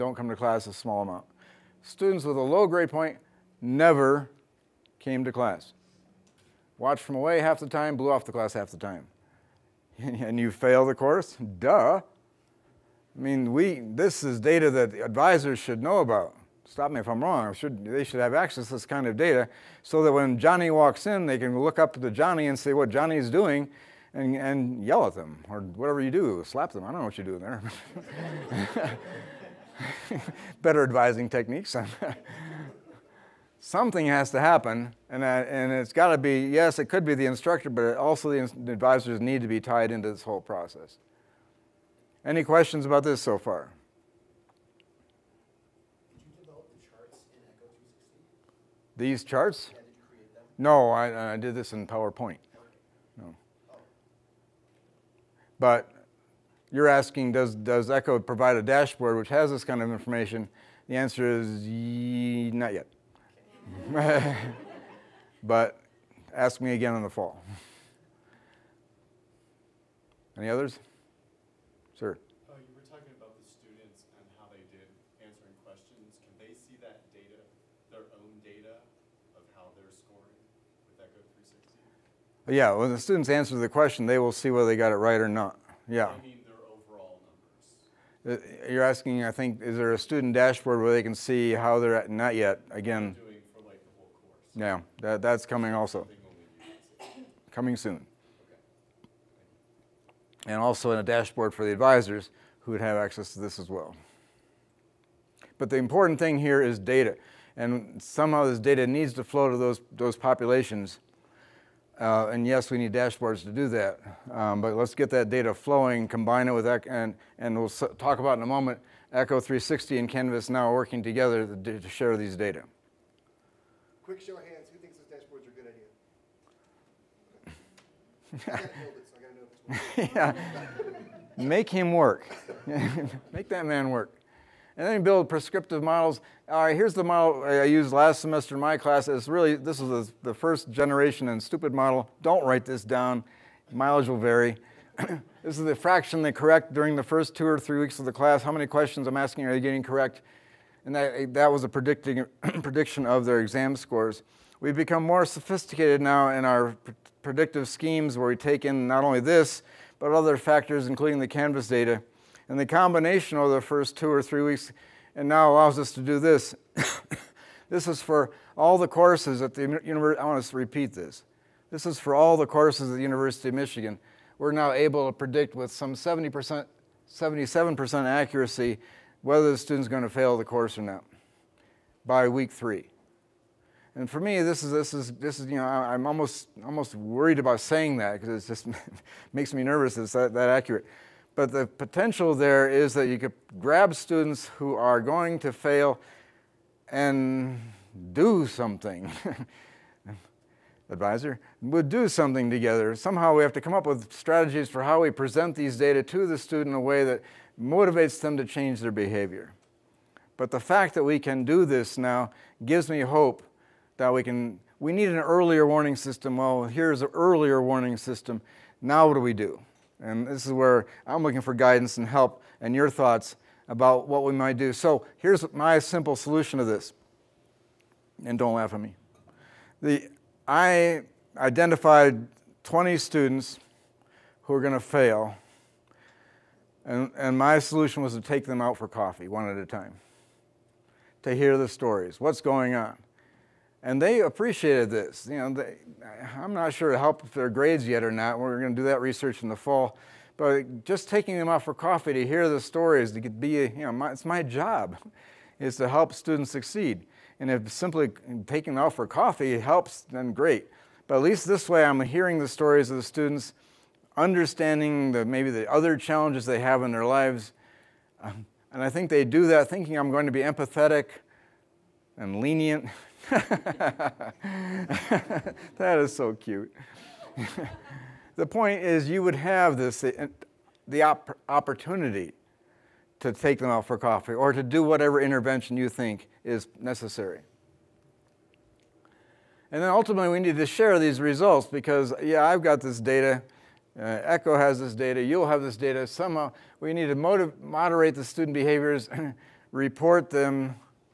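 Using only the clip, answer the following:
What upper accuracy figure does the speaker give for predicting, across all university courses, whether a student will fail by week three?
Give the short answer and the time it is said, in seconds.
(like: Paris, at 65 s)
77%, at 177 s.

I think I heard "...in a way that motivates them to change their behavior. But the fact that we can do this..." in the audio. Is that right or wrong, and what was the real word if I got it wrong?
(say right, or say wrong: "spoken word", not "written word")
right.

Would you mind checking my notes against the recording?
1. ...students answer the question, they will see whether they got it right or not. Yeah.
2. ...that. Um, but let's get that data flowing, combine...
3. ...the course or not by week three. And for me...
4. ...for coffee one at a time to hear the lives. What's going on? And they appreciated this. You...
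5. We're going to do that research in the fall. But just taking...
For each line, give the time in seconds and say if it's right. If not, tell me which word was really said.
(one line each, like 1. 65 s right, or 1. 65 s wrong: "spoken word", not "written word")
1. 82 s right
2. 113 s right
3. 180 s right
4. 238 s wrong: "stories", not "lives"
5. 248 s right.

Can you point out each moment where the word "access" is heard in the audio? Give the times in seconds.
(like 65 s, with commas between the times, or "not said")
18 s, 102 s.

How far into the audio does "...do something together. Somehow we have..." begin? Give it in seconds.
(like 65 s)
201 s.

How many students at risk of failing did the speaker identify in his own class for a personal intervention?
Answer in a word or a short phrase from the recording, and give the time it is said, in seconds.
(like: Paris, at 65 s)
20, at 232 s.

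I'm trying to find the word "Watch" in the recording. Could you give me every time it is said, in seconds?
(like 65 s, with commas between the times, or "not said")
6 s.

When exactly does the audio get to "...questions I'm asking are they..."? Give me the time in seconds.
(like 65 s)
148 s.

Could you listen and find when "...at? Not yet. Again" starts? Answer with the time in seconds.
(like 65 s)
91 s.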